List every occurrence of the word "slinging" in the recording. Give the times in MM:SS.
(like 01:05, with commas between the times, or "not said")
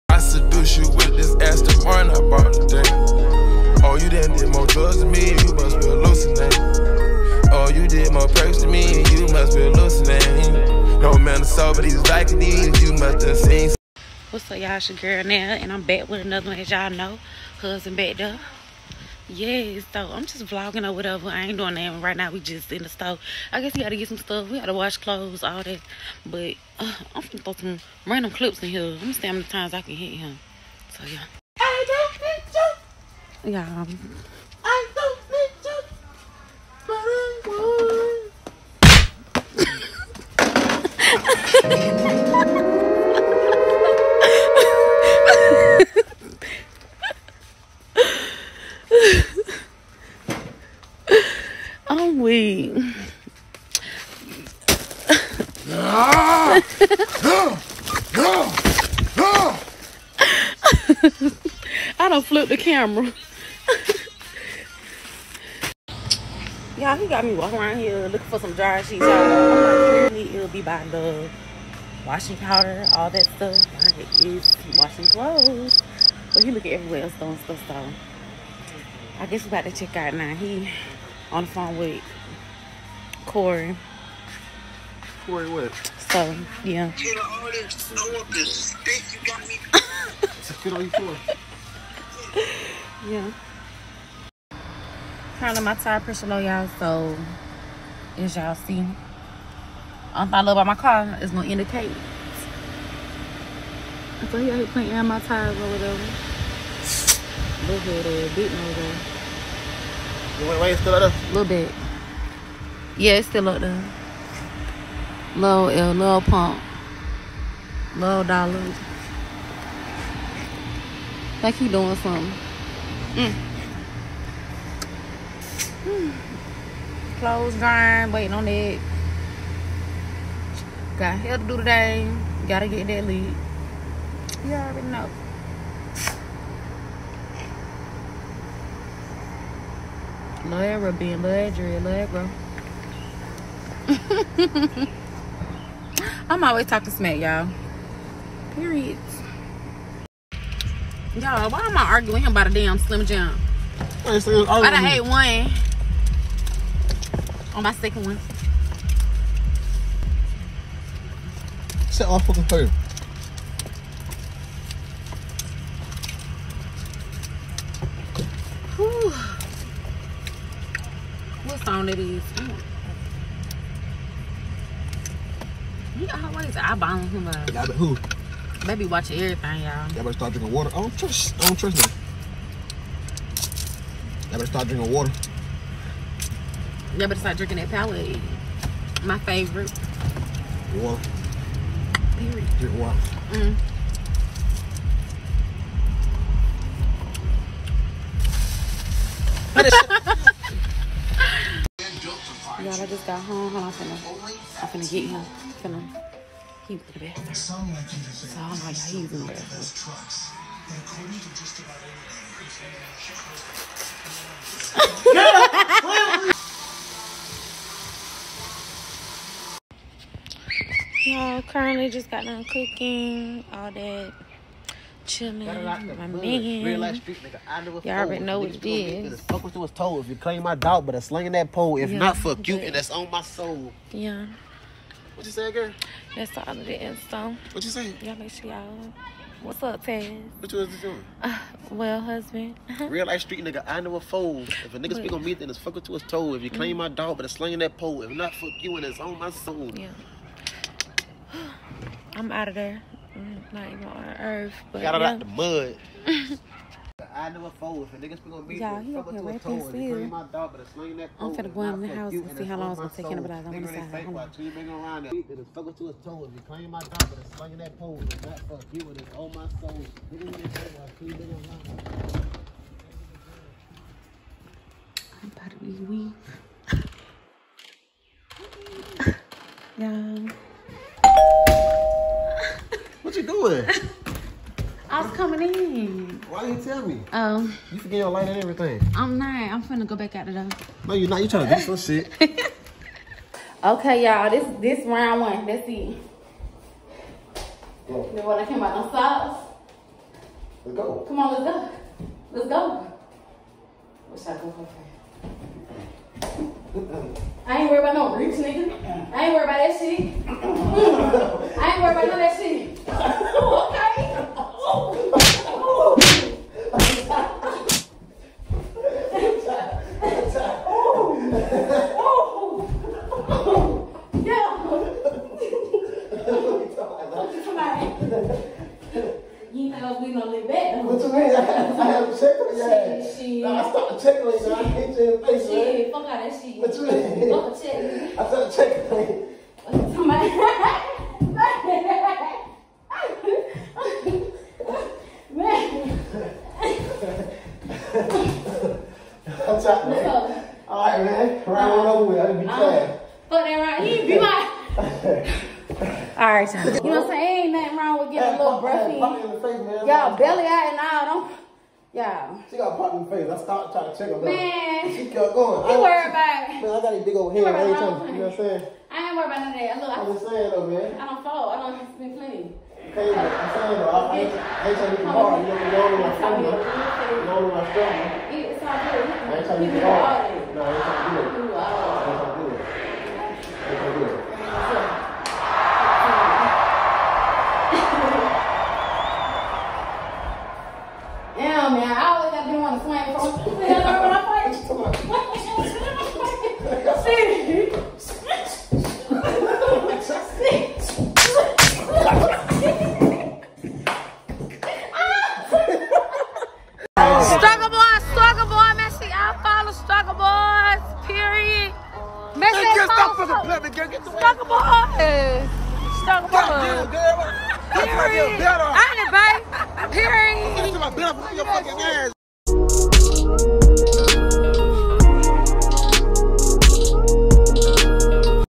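03:51, 04:07.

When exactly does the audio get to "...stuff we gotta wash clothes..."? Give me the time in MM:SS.
00:24.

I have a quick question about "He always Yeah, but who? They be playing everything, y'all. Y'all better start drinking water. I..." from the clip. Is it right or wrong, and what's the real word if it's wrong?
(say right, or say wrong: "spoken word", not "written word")
wrong: "watching", not "playing".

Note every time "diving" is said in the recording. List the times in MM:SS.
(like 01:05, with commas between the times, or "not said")
not said.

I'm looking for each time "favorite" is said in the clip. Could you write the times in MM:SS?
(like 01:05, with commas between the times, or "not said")
03:09.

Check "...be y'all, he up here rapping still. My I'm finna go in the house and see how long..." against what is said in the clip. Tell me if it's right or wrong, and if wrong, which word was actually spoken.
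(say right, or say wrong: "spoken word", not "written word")
right.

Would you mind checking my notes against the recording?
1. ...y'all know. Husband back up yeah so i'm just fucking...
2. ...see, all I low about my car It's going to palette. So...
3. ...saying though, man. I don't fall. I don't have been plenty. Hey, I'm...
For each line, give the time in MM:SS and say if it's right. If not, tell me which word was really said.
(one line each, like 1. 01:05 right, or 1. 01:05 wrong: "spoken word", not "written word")
1. 00:16 wrong: "vlogging", not "fucking"
2. 01:38 wrong: "indicate", not "palette"
3. 06:10 right.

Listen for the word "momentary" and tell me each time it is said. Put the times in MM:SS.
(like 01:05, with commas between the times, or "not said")
not said.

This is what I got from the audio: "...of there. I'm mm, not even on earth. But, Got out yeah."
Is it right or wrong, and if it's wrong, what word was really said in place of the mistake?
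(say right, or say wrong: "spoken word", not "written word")
right.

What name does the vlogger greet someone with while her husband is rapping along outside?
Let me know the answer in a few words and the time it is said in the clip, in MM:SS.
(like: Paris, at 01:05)
Taz, at 03:59.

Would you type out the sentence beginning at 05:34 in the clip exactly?
check I hit you in the face, man.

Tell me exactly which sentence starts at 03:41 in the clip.
Y'all currently just got done cooking, all that chilling, like my man.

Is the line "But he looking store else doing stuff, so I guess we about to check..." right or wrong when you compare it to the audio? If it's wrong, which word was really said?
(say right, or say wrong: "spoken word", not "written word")
wrong: "everywhere", not "store".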